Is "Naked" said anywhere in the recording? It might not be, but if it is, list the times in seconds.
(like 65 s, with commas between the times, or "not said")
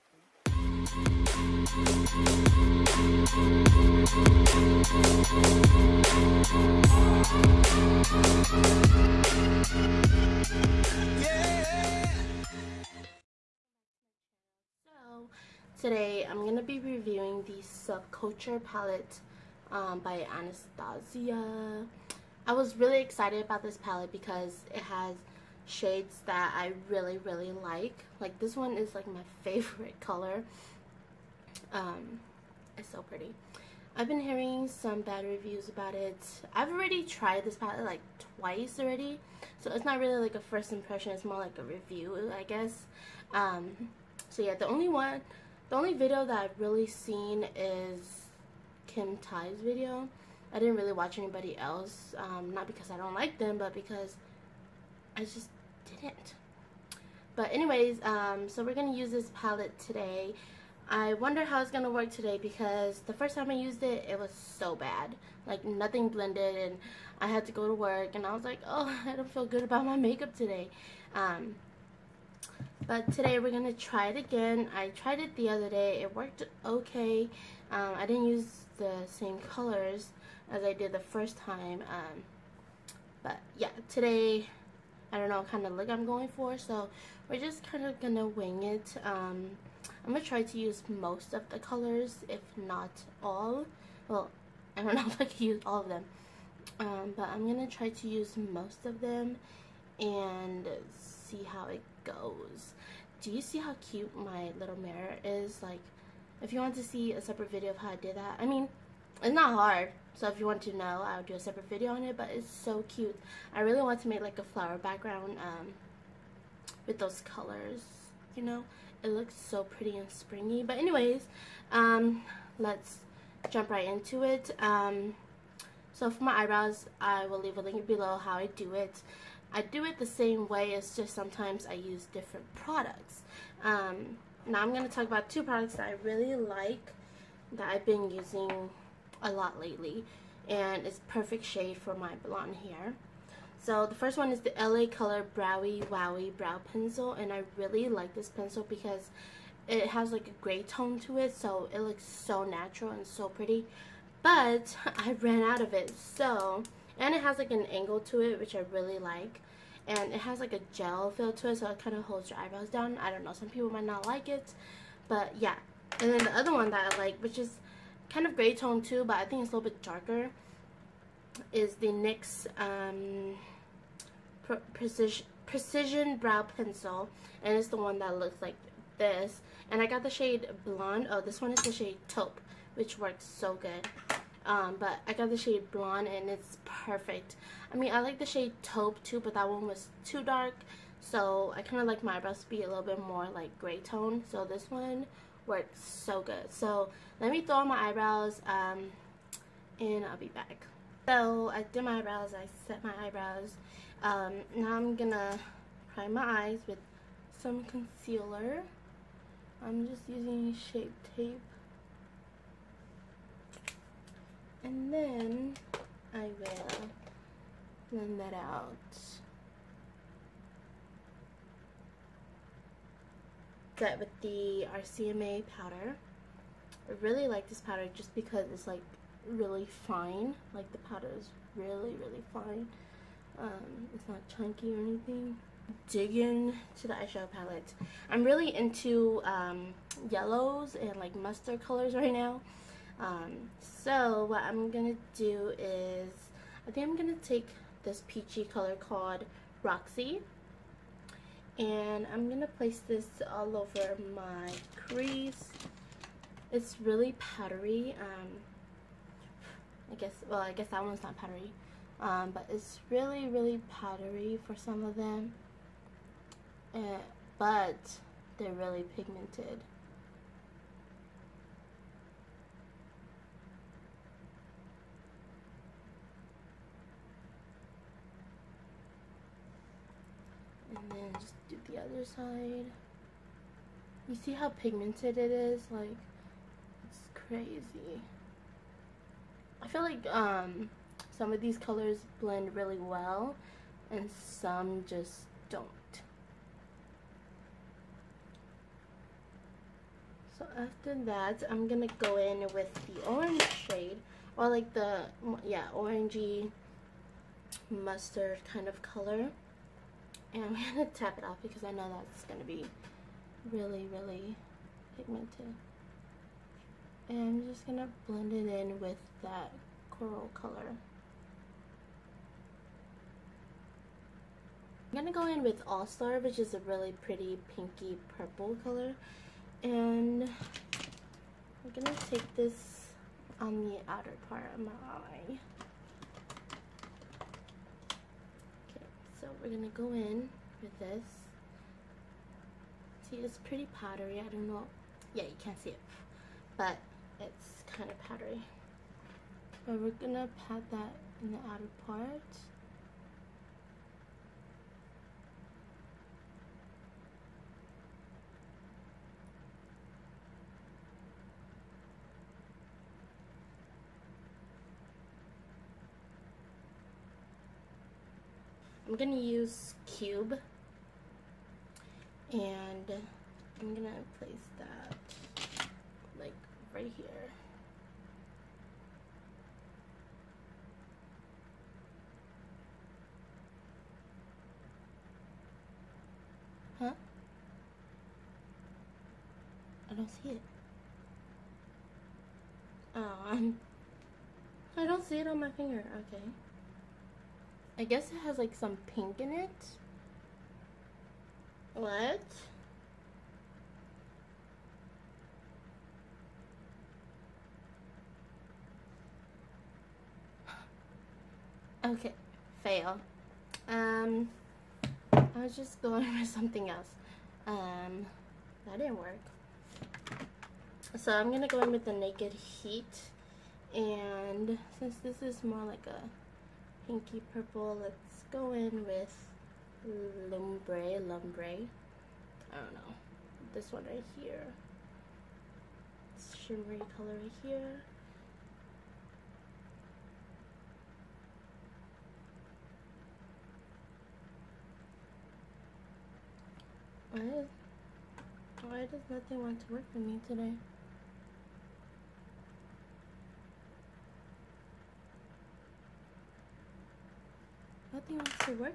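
421 s.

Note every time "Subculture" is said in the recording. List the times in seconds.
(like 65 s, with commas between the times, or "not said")
17 s.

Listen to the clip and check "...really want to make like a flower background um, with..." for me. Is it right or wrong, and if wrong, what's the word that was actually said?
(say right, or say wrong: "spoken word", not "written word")
right.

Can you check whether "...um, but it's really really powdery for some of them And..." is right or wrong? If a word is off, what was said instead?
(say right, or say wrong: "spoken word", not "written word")
right.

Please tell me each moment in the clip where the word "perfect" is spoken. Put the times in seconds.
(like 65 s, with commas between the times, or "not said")
141 s, 186 s.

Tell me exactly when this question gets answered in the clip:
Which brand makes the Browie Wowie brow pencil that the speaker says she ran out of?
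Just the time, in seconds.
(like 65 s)
144 s.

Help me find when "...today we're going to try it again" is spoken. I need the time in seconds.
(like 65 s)
73 s.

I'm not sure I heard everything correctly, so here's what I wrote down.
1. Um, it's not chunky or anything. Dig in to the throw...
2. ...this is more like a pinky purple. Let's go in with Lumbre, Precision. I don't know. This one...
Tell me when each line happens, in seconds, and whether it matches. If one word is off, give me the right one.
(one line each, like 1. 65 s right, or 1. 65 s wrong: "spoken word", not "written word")
1. 233 s wrong: "eyeshadow", not "throw"
2. 425 s wrong: "Lumbre", not "Precision".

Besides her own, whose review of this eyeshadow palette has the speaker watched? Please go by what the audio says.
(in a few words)
Kim Tai.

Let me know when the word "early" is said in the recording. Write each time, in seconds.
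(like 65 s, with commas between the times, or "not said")
not said.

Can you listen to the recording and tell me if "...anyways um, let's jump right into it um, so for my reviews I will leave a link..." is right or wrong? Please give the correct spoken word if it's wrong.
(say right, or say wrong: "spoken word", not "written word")
wrong: "eyebrows", not "reviews".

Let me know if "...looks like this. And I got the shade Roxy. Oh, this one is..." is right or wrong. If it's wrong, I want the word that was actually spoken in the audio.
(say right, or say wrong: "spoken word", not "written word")
wrong: "Blonde", not "Roxy".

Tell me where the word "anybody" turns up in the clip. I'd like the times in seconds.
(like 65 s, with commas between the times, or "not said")
51 s.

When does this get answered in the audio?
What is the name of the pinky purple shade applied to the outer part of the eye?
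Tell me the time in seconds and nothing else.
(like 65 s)
325 s.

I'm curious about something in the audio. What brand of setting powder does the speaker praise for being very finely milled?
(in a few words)
RCMA.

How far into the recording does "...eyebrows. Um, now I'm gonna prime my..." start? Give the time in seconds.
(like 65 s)
203 s.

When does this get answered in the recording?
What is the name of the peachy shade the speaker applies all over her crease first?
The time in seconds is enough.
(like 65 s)
249 s.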